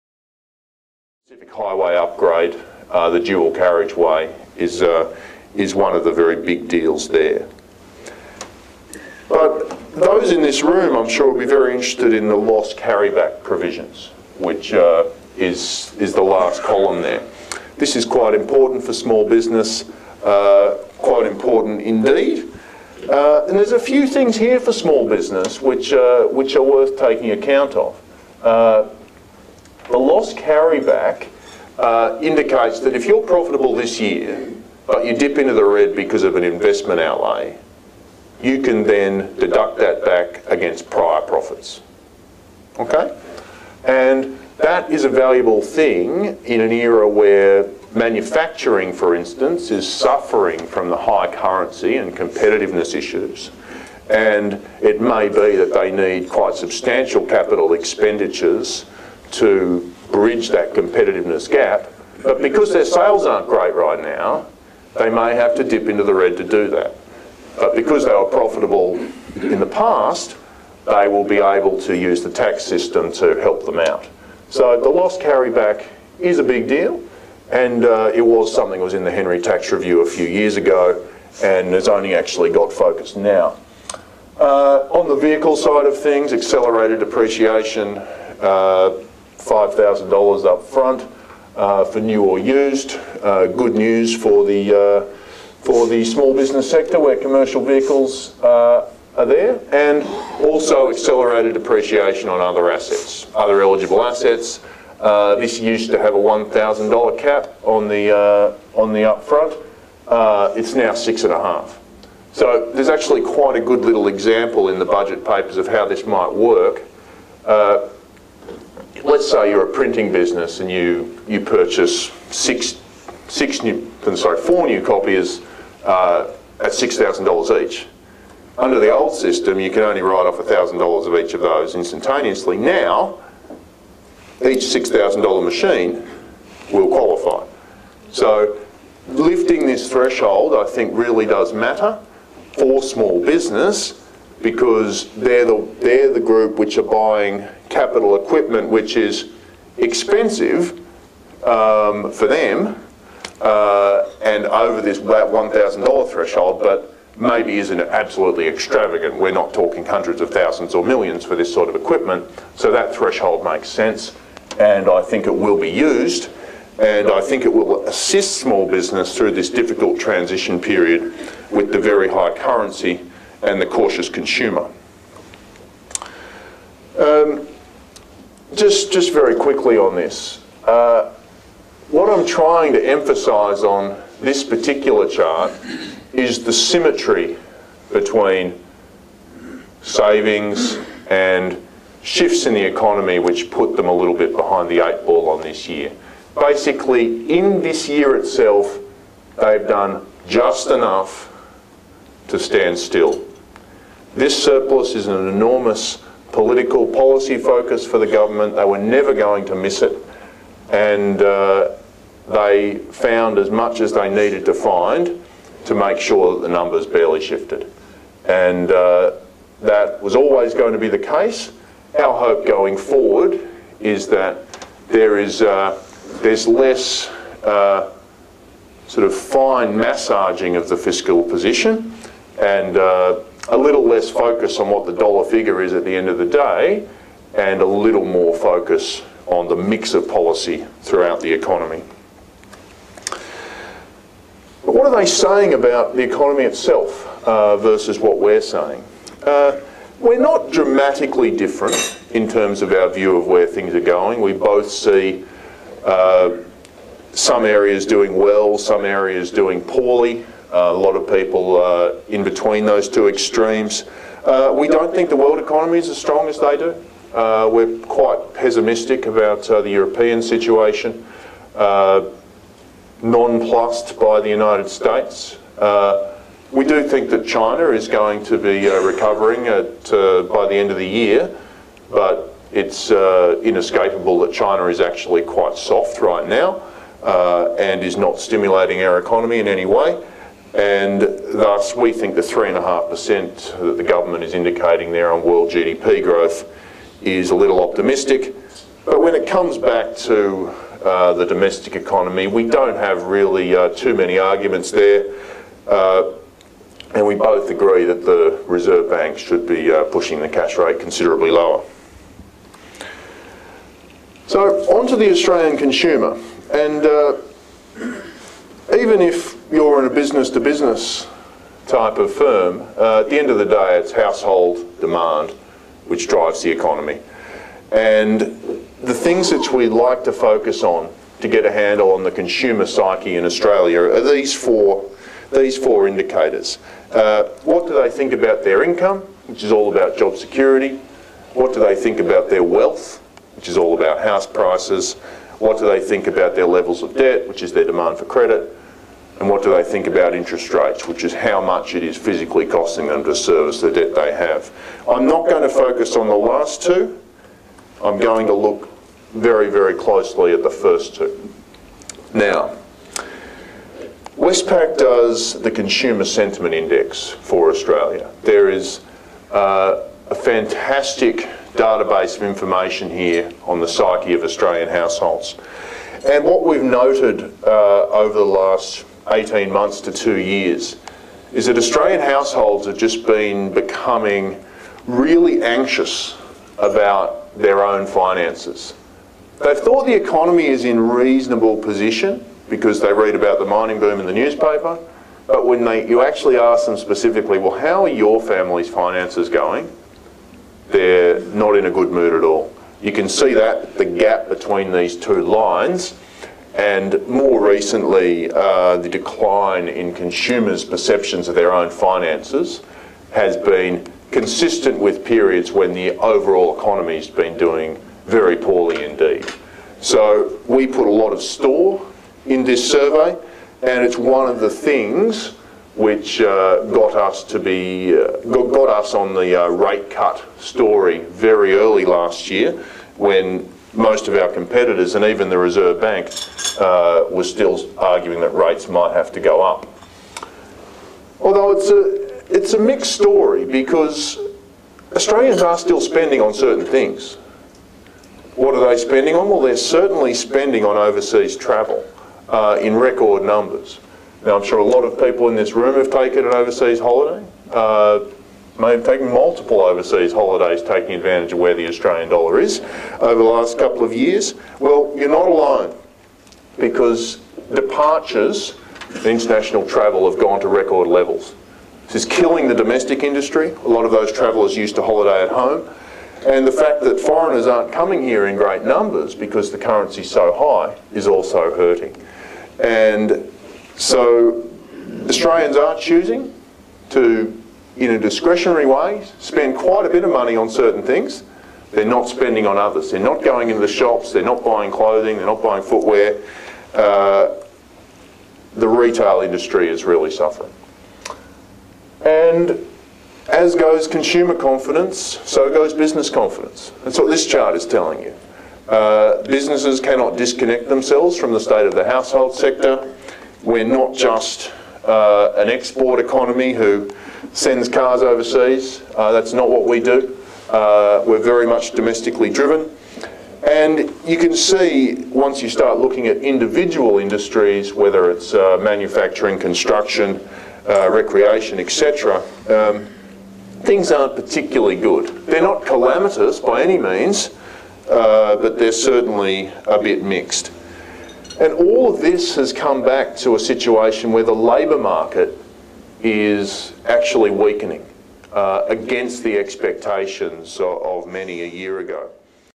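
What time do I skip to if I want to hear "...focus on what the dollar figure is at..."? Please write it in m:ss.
3:54.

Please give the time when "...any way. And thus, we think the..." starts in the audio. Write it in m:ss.
4:49.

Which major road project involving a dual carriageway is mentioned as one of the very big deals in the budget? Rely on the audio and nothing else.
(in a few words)
Pacific Highway upgrade.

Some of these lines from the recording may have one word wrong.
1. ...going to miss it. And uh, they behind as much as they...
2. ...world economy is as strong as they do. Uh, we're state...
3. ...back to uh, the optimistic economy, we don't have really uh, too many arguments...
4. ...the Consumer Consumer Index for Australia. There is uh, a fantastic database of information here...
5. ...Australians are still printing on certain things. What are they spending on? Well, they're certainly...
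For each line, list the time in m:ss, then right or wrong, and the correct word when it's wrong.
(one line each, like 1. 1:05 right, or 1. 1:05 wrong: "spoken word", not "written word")
1. 3:29 wrong: "found", not "behind"
2. 4:25 wrong: "quite", not "state"
3. 4:59 wrong: "domestic", not "optimistic"
4. 6:05 wrong: "Sentiment", not "Consumer"
5. 7:24 wrong: "spending", not "printing".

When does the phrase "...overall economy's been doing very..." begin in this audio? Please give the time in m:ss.
6:55.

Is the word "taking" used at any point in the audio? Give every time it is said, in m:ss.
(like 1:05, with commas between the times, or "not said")
0:26, 7:40.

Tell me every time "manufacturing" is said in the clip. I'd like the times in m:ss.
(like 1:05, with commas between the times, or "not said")
0:47, 8:48.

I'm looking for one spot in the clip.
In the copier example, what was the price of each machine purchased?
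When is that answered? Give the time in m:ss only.
2:06.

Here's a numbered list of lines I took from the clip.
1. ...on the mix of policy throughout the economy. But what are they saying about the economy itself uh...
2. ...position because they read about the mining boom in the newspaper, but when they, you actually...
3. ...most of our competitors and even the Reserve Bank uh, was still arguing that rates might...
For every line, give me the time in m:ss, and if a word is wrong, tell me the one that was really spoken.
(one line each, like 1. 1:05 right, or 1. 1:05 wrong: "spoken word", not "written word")
1. 3:59 right
2. 6:31 right
3. 7:13 right.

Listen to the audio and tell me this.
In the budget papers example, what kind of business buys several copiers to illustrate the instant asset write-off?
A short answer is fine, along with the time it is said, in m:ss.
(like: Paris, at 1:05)
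printing business, at 1:59.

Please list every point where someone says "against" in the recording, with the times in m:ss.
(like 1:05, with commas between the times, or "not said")
0:40, 9:08.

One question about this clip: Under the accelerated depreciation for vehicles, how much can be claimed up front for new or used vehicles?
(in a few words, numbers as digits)
$5,000.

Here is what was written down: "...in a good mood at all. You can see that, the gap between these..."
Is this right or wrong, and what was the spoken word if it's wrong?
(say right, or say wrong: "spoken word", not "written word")
right.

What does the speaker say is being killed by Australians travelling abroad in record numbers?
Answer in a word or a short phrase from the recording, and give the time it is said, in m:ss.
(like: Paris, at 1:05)
domestic industry, at 7:52.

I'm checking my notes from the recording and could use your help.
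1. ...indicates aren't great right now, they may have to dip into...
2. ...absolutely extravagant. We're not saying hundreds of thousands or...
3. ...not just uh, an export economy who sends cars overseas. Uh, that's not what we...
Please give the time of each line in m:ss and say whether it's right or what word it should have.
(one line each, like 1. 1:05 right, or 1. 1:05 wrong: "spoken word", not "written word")
1. 1:02 wrong: "sales", not "indicates"
2. 2:37 wrong: "talking", not "saying"
3. 8:33 right.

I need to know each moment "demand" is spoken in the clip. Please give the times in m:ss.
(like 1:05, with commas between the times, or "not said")
5:24, 5:47.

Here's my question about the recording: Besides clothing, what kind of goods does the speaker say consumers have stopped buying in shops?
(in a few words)
footwear.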